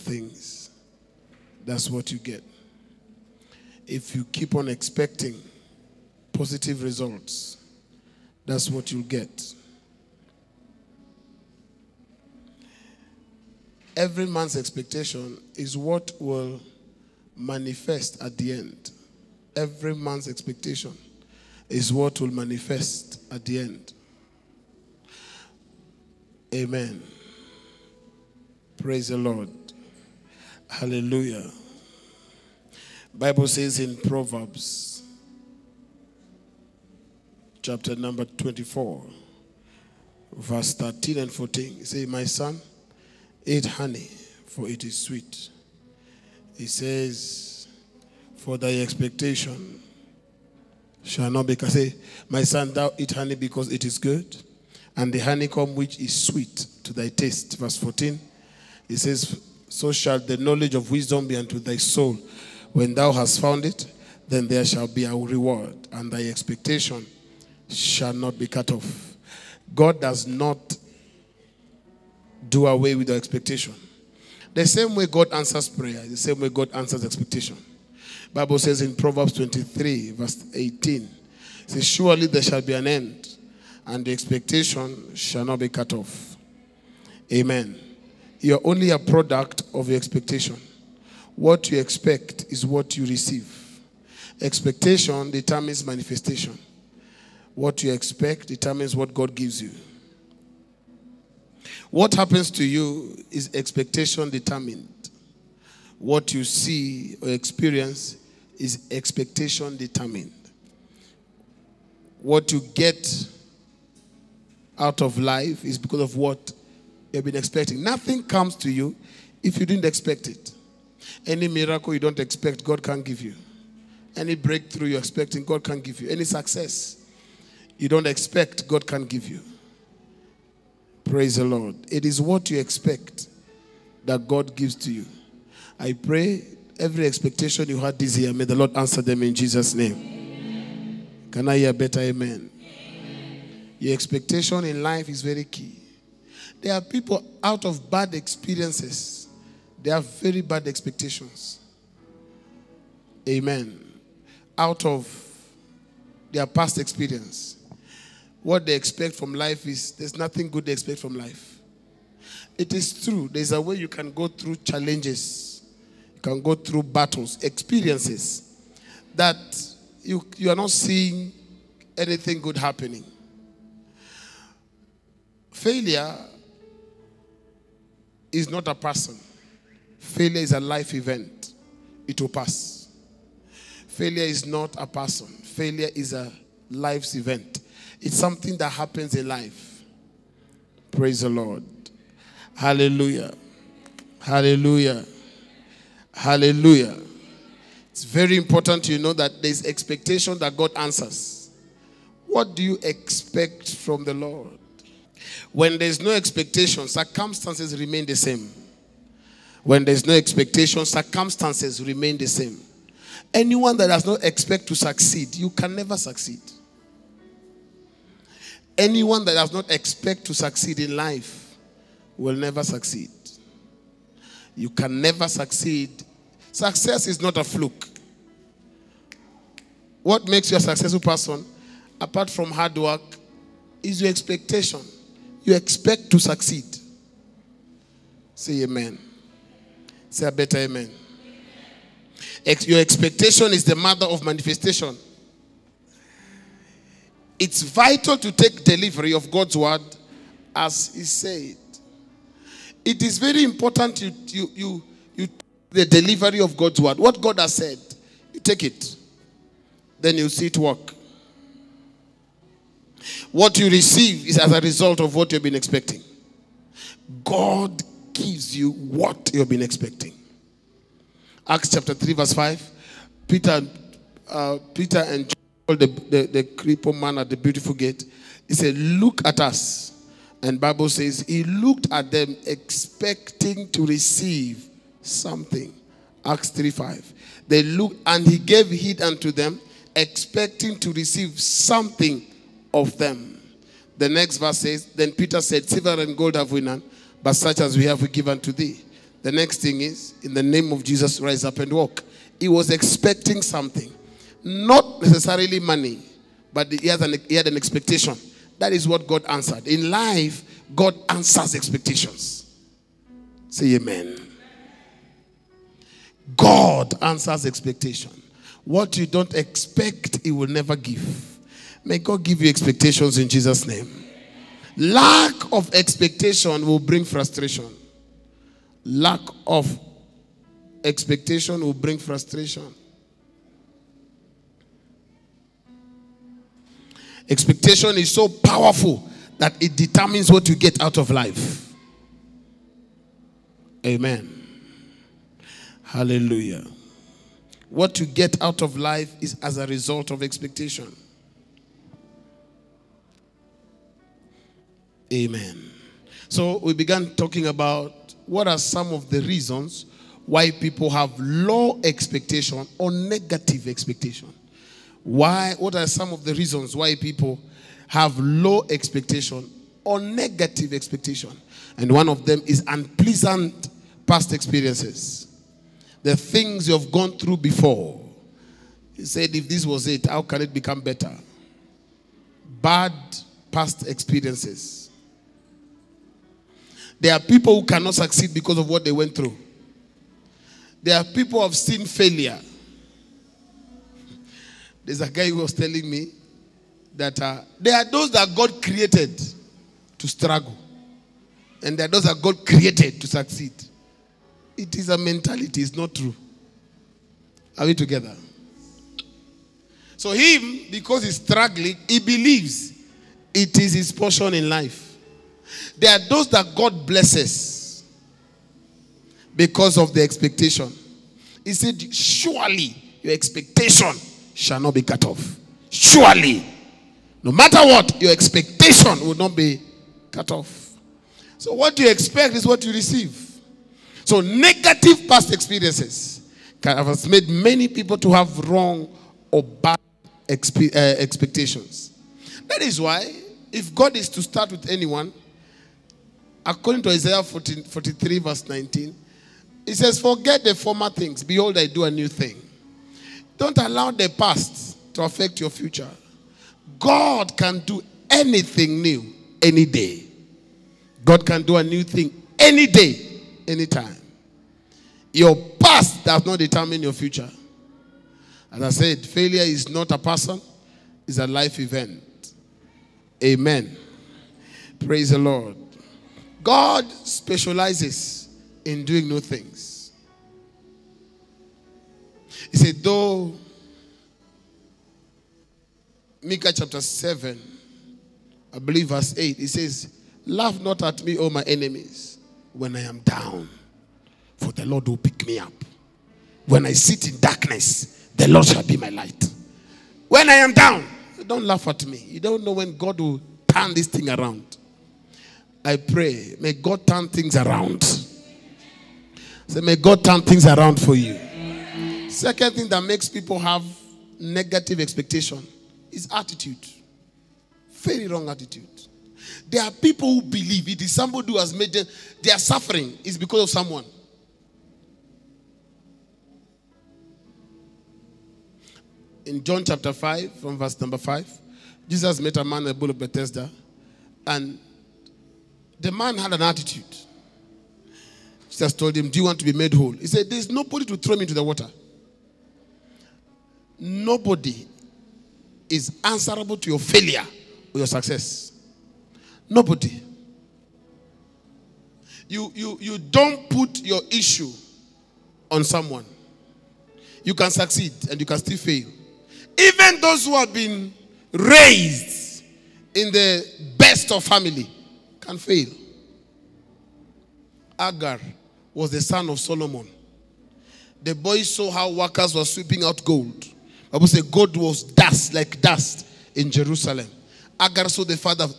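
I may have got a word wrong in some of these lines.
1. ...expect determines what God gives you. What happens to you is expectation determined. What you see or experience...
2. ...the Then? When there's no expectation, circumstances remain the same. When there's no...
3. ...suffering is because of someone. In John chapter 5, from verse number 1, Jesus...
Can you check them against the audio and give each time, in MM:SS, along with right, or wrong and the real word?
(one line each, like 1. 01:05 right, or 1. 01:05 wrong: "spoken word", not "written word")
1. 01:37 right
2. 03:24 wrong: "Lord", not "Then"
3. 08:42 wrong: "5", not "1".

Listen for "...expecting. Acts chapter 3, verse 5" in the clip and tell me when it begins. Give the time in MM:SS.
04:29.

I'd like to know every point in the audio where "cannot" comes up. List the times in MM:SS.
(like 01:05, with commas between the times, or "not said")
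06:27.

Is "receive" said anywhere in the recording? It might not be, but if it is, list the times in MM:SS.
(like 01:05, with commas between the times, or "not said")
01:33, 04:23, 04:43, 04:50, 07:12.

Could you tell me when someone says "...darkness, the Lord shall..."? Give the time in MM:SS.
08:17.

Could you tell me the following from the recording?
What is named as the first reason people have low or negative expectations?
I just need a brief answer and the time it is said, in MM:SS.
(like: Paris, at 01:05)
Unpleasant past experiences, at 06:12.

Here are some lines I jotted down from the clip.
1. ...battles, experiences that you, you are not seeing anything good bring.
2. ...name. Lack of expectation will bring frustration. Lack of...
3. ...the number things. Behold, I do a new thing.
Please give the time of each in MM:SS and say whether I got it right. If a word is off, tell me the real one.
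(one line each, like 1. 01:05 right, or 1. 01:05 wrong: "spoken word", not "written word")
1. 02:46 wrong: "happening", not "bring"
2. 05:23 right
3. 07:30 wrong: "former", not "number".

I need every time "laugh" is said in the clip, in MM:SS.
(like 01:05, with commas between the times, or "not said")
08:10, 08:21.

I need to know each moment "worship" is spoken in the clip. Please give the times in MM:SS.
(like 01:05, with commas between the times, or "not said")
not said.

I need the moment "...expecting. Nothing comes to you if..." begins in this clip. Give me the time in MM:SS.
01:57.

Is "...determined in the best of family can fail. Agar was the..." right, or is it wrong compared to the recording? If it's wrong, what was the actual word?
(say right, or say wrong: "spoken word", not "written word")
wrong: "raised", not "determined".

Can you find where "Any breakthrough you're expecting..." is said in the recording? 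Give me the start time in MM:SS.
02:04.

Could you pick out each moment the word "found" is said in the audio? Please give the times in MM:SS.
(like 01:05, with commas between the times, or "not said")
01:03.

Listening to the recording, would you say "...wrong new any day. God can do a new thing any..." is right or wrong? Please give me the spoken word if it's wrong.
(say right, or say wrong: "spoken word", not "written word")
wrong: "anything", not "wrong".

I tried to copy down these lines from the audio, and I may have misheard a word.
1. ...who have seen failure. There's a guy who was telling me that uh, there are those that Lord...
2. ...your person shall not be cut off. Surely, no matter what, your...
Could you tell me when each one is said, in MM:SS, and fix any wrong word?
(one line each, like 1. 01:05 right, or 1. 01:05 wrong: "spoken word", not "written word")
1. 06:31 wrong: "God", not "Lord"
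2. 07:03 wrong: "expectation", not "person".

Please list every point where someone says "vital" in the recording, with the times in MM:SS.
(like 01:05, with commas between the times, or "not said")
04:07.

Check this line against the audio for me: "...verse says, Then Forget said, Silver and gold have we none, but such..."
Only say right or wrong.
wrong.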